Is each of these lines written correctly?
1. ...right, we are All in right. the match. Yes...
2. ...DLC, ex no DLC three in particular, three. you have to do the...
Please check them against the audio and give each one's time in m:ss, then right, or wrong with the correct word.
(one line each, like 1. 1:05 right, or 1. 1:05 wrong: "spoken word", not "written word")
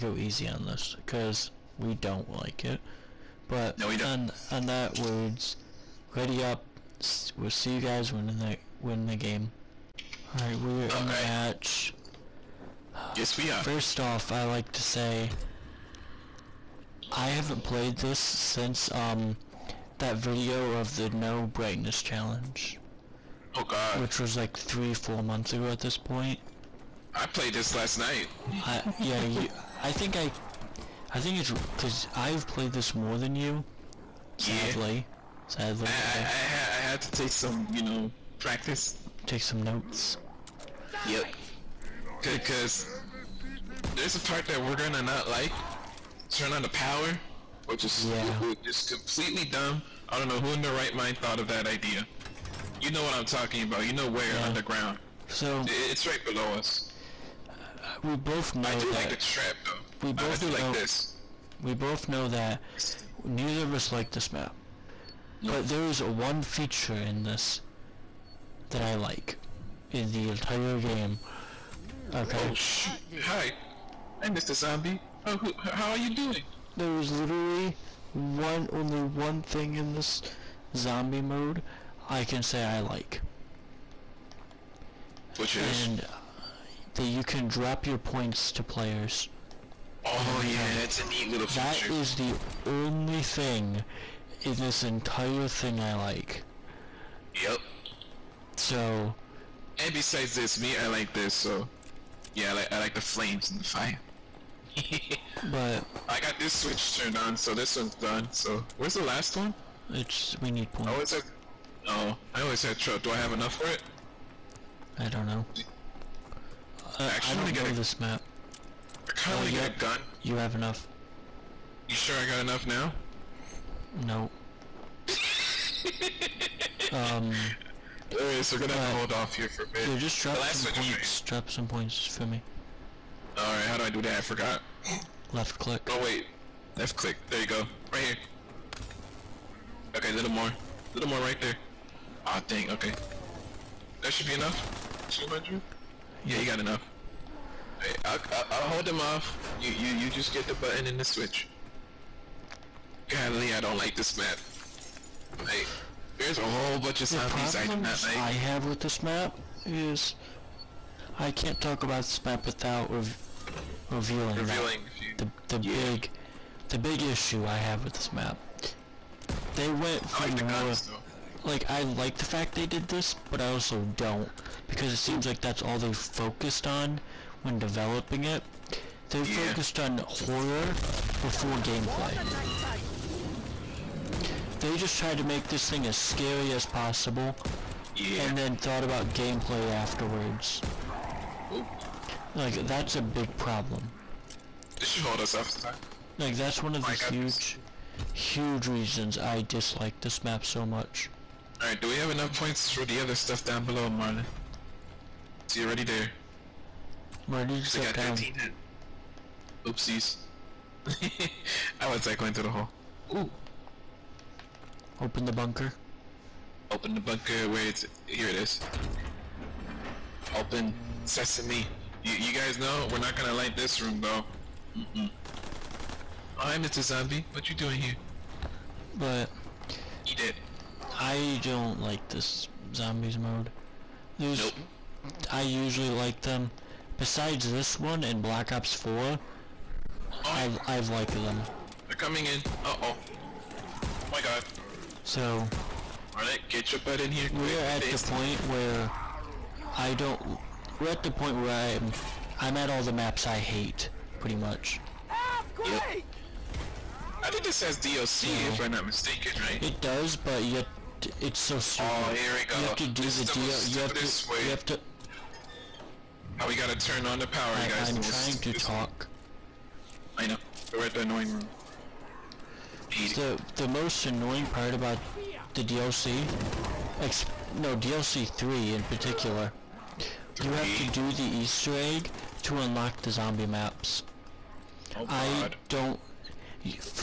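1. 0:10 right
2. 4:35 right.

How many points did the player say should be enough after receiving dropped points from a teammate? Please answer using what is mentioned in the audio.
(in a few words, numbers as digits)
200.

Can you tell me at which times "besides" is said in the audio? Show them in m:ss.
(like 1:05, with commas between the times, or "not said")
1:39, 3:57.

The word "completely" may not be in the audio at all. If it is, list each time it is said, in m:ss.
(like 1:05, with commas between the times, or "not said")
0:48.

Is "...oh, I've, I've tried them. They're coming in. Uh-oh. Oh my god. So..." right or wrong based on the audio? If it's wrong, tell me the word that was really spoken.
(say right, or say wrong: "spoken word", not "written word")
wrong: "liked", not "tried".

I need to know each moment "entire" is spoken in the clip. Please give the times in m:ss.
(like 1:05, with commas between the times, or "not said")
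1:10, 1:34.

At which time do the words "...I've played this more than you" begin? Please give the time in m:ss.
0:32.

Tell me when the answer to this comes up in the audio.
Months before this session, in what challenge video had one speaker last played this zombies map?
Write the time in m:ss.
0:21.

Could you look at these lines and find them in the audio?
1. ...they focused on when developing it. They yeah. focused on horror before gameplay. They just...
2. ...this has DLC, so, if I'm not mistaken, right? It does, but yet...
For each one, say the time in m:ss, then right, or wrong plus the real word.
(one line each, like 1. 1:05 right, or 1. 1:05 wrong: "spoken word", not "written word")
1. 2:55 right
2. 4:17 right.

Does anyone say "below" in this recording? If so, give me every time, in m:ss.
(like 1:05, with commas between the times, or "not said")
0:56, 3:23.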